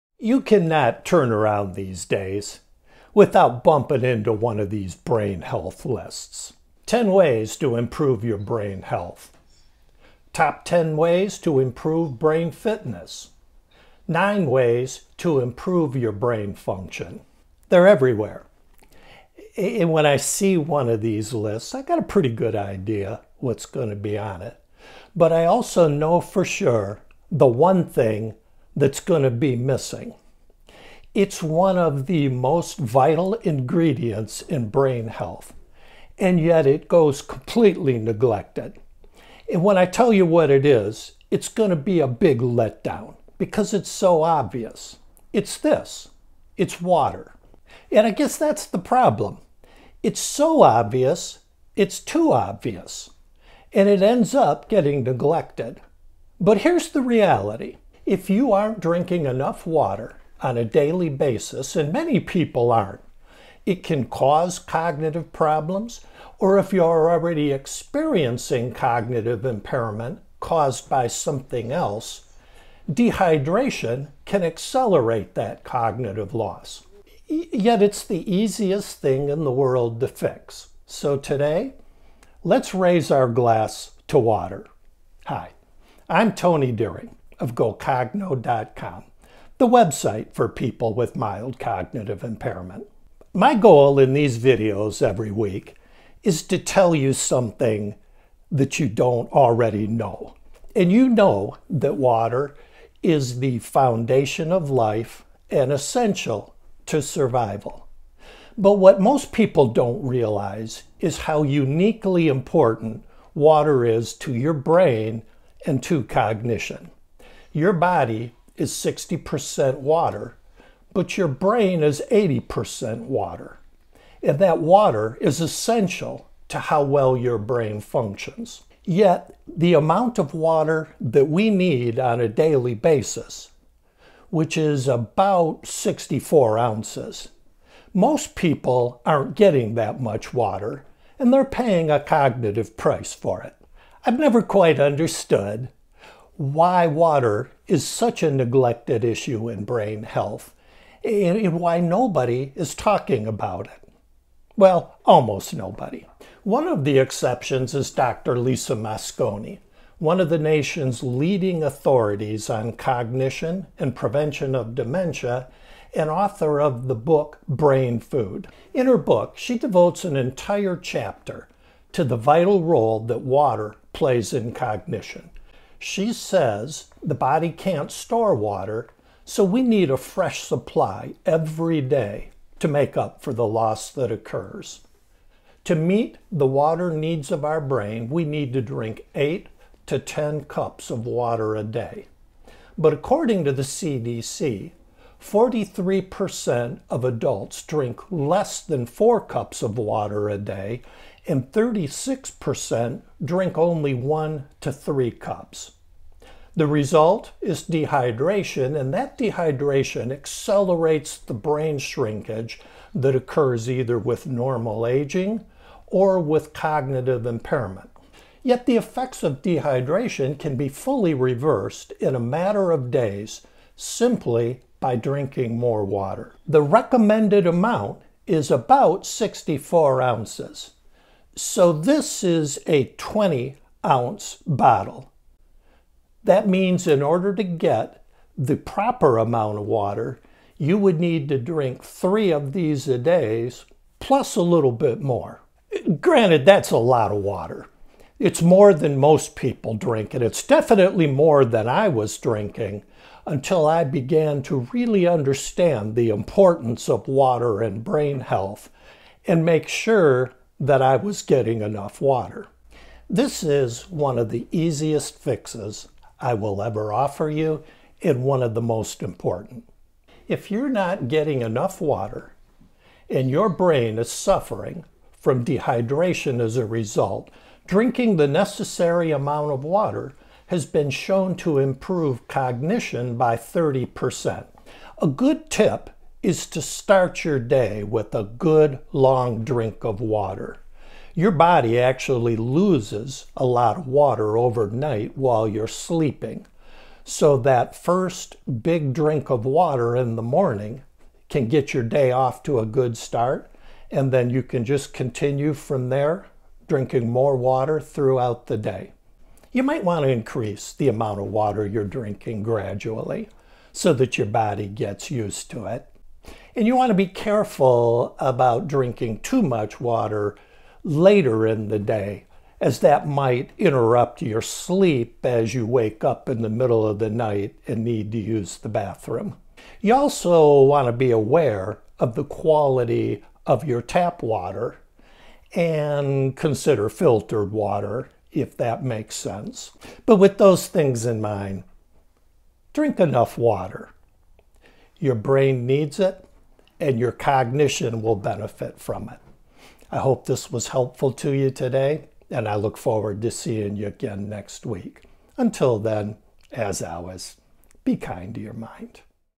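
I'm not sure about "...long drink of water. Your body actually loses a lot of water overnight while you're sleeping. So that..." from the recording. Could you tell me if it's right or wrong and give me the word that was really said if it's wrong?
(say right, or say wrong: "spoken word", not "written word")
right.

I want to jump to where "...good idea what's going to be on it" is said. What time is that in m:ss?
0:22.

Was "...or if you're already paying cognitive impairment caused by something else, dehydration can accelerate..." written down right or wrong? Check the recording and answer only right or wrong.
wrong.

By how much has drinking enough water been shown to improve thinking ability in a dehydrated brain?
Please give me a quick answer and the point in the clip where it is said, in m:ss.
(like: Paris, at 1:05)
30%, at 4:43.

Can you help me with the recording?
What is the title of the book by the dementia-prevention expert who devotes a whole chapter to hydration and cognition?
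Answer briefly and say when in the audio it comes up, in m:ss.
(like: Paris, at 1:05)
Brain Food, at 2:47.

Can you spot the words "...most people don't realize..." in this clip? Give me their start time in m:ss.
1:49.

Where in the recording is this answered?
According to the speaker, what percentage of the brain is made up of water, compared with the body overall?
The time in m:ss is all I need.
2:02.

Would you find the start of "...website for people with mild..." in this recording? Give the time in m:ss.
1:29.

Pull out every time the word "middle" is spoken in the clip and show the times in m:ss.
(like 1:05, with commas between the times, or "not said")
5:26.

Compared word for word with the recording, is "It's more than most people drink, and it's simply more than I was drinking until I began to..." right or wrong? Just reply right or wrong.
wrong.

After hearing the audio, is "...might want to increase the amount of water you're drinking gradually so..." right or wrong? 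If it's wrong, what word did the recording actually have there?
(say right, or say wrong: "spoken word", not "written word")
right.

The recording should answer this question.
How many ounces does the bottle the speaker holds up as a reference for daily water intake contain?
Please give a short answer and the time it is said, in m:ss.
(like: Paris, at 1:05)
20 ounces, at 3:52.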